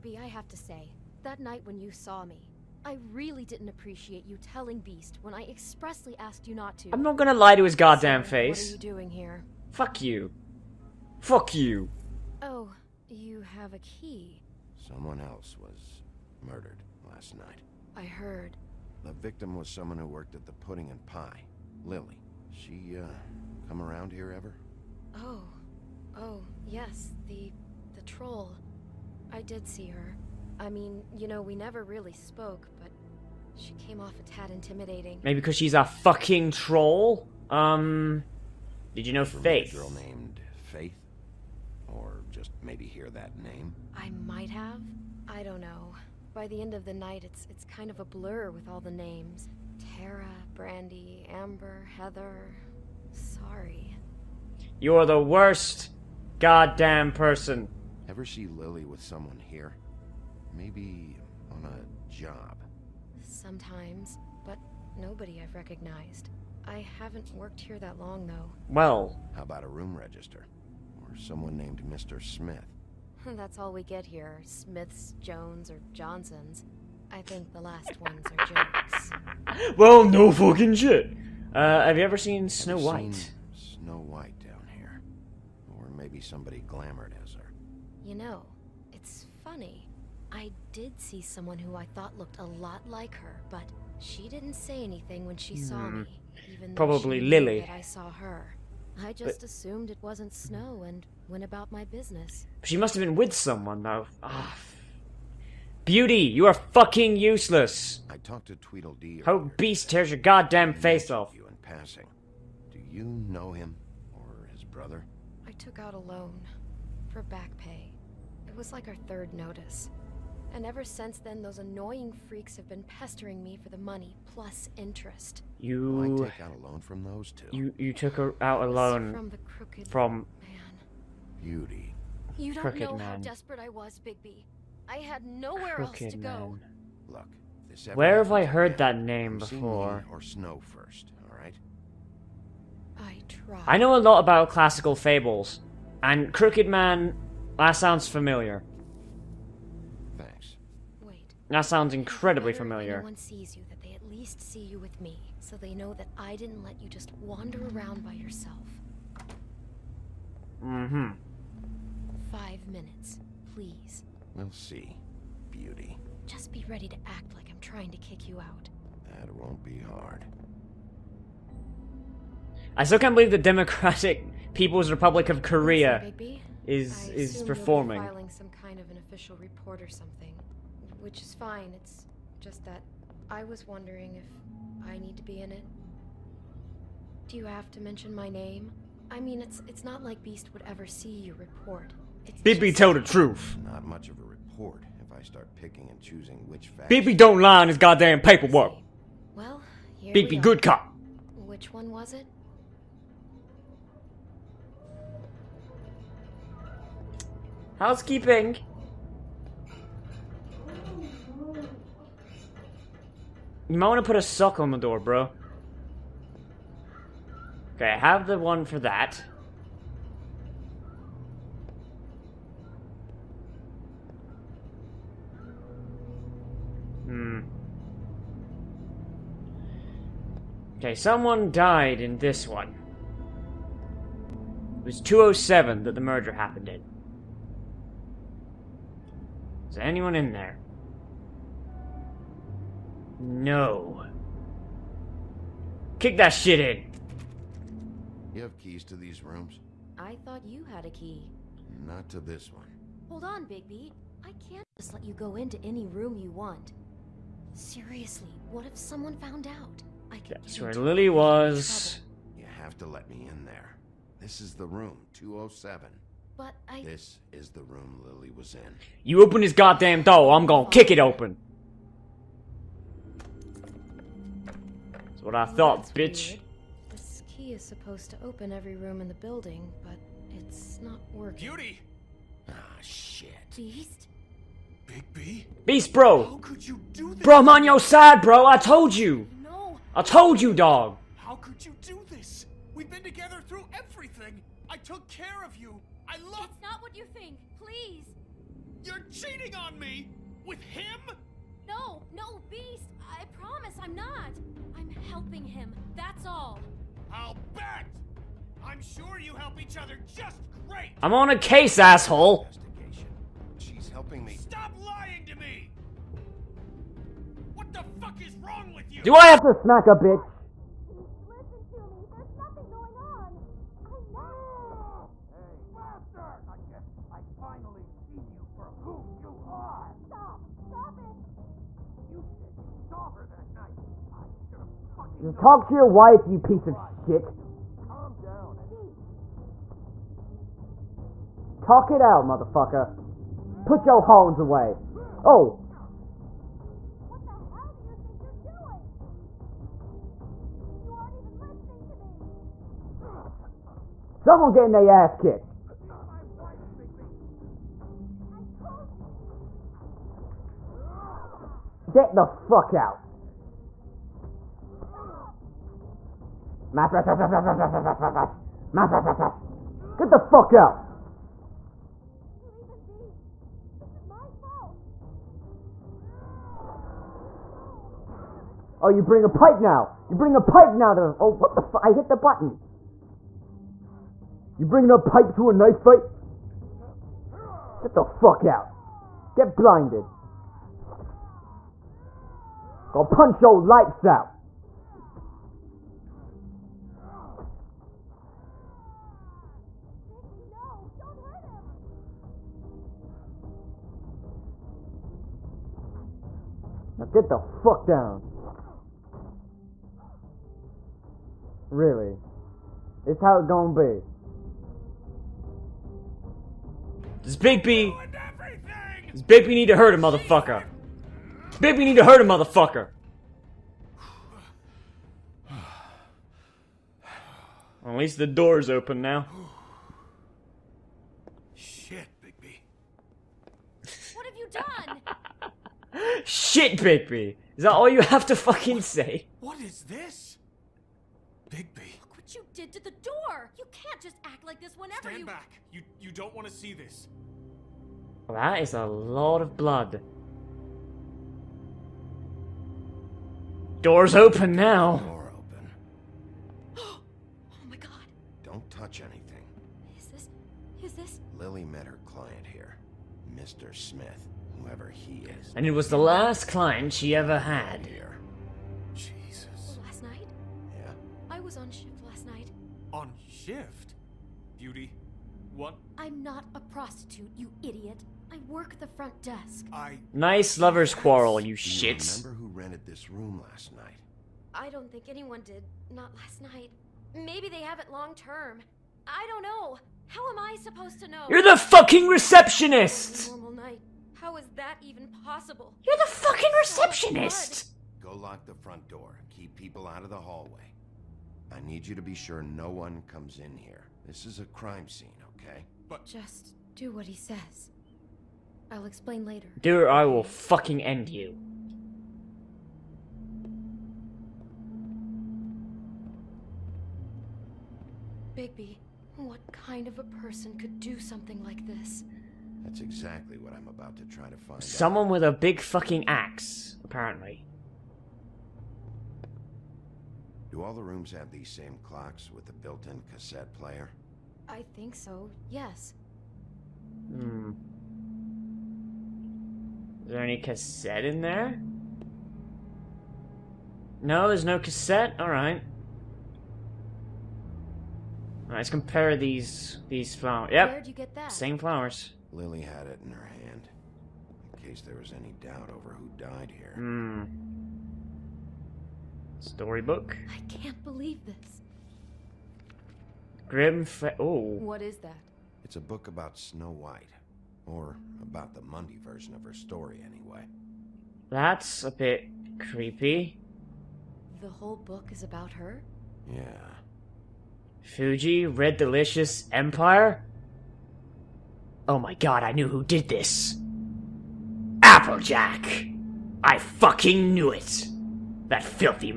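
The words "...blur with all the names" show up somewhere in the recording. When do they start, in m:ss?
0:48.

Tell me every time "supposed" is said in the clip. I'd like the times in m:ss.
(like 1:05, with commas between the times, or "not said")
4:37, 8:10.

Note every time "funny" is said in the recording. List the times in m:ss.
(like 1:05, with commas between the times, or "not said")
1:29.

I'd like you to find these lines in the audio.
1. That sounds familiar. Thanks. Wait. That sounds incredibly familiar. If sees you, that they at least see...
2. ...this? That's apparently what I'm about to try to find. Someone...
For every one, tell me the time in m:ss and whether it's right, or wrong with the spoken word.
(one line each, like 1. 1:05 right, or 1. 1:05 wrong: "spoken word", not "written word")
1. 2:27 right
2. 8:41 wrong: "exactly", not "apparently".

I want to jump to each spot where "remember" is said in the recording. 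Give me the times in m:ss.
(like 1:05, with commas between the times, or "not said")
8:02.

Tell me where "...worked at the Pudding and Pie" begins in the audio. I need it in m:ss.
0:20.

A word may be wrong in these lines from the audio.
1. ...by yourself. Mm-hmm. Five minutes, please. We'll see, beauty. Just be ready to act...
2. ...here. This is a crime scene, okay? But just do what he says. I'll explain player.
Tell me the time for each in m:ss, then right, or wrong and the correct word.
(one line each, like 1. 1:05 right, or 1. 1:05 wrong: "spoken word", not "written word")
1. 2:38 right
2. 8:23 wrong: "later", not "player".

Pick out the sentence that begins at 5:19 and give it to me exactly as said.
Do I have to smack a bitch?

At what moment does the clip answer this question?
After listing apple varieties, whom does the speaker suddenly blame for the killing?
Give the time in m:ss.
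9:44.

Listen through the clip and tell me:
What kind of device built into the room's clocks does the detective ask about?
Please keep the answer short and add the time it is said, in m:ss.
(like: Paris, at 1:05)
Cassette player, at 8:53.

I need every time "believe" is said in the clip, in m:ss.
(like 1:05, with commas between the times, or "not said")
2:53, 9:20.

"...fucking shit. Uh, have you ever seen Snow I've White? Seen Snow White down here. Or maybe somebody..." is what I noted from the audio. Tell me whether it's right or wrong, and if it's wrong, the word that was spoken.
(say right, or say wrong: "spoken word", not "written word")
right.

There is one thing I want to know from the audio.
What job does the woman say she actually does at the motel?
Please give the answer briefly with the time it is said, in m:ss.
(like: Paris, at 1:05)
Front desk, at 7:58.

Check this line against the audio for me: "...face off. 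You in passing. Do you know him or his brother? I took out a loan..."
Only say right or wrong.
right.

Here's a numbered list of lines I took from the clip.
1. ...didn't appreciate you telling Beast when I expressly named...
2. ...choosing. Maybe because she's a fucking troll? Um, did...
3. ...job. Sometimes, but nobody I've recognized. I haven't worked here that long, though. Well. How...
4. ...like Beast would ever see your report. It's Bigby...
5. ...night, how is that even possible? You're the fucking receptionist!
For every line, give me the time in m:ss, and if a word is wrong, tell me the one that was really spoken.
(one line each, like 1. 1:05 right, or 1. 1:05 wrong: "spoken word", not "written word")
1. 0:03 wrong: "asked", not "named"
2. 0:34 wrong: "intimidating", not "choosing"
3. 1:02 right
4. 3:10 right
5. 8:13 right.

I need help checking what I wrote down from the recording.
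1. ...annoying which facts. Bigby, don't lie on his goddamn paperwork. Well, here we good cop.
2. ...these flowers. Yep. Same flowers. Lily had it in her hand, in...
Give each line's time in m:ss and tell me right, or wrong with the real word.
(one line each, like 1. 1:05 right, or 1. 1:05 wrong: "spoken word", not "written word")
1. 3:15 wrong: "choosing", not "annoying"
2. 9:09 right.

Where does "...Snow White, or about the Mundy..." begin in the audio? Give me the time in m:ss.
9:26.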